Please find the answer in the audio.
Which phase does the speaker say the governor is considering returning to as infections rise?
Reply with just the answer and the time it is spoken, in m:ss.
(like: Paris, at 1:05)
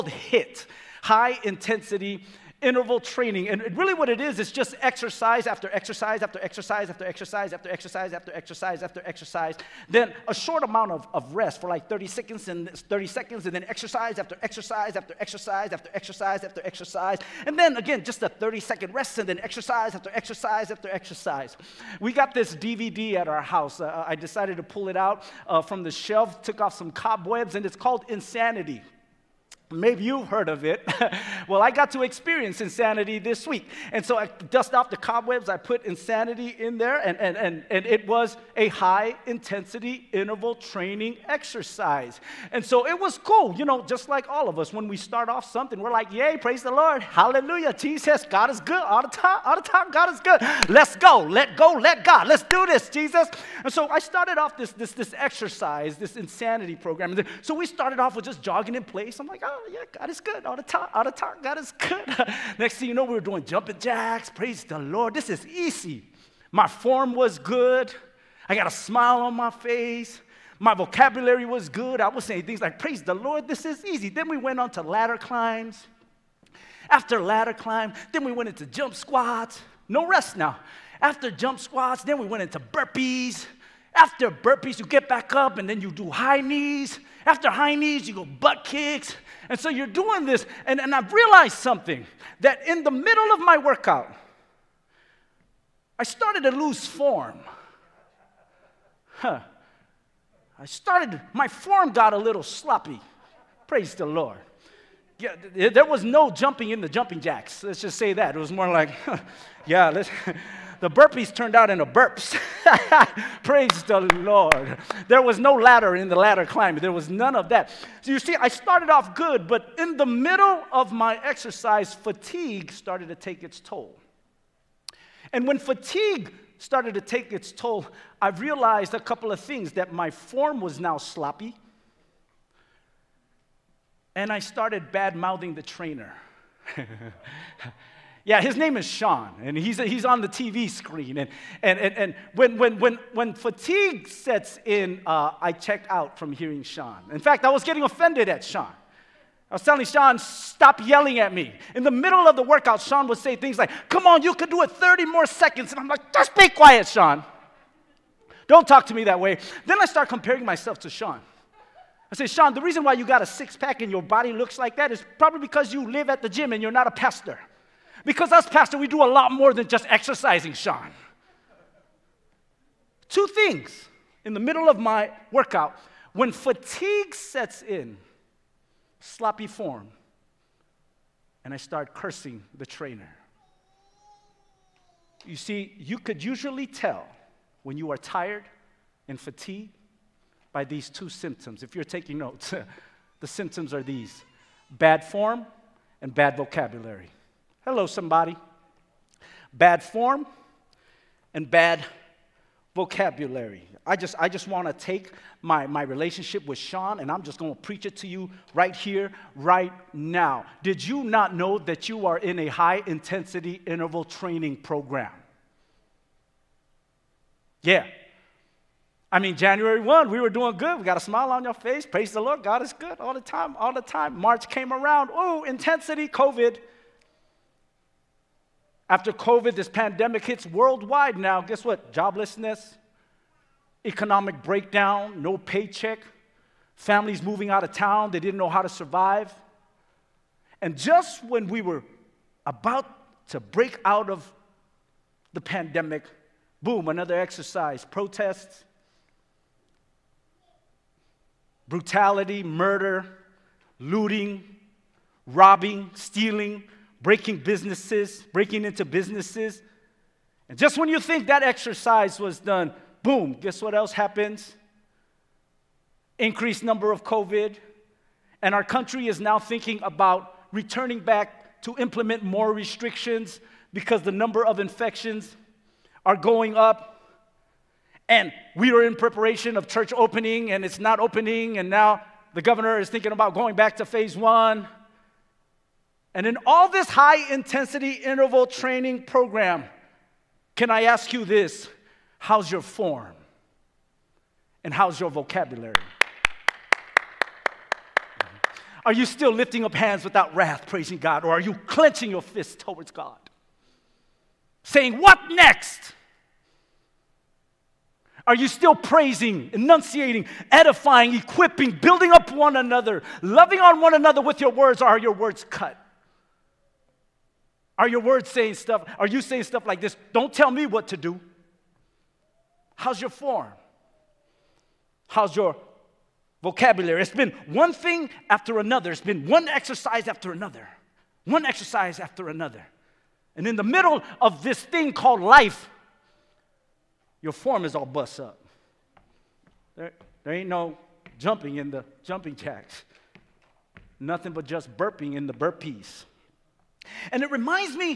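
Phase one, at 4:43.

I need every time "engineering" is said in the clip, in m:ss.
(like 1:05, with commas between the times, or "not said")
not said.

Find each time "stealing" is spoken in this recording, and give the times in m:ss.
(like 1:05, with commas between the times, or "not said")
4:15.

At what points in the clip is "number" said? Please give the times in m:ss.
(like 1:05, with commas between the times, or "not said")
4:26, 4:34.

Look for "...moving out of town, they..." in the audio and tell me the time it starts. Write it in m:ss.
3:57.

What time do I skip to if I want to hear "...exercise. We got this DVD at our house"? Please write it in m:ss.
0:20.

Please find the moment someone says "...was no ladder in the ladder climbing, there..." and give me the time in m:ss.
1:55.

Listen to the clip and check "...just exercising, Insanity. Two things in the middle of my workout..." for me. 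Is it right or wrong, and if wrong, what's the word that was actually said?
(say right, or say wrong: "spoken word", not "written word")
wrong: "Sean", not "Insanity".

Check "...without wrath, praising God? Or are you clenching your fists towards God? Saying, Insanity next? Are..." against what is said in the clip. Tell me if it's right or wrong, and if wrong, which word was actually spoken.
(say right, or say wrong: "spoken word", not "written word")
wrong: "What", not "Insanity".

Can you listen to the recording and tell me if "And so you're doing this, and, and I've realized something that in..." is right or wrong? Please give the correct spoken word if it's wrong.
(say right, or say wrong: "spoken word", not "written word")
right.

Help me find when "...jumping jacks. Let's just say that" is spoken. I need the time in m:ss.
1:46.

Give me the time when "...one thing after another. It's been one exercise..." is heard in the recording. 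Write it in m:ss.
5:27.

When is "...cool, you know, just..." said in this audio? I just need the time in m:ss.
0:43.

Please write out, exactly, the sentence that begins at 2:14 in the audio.
And I started bad mouthing the trainer.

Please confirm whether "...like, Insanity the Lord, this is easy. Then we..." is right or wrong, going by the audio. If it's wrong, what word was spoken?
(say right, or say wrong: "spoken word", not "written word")
wrong: "Praise", not "Insanity".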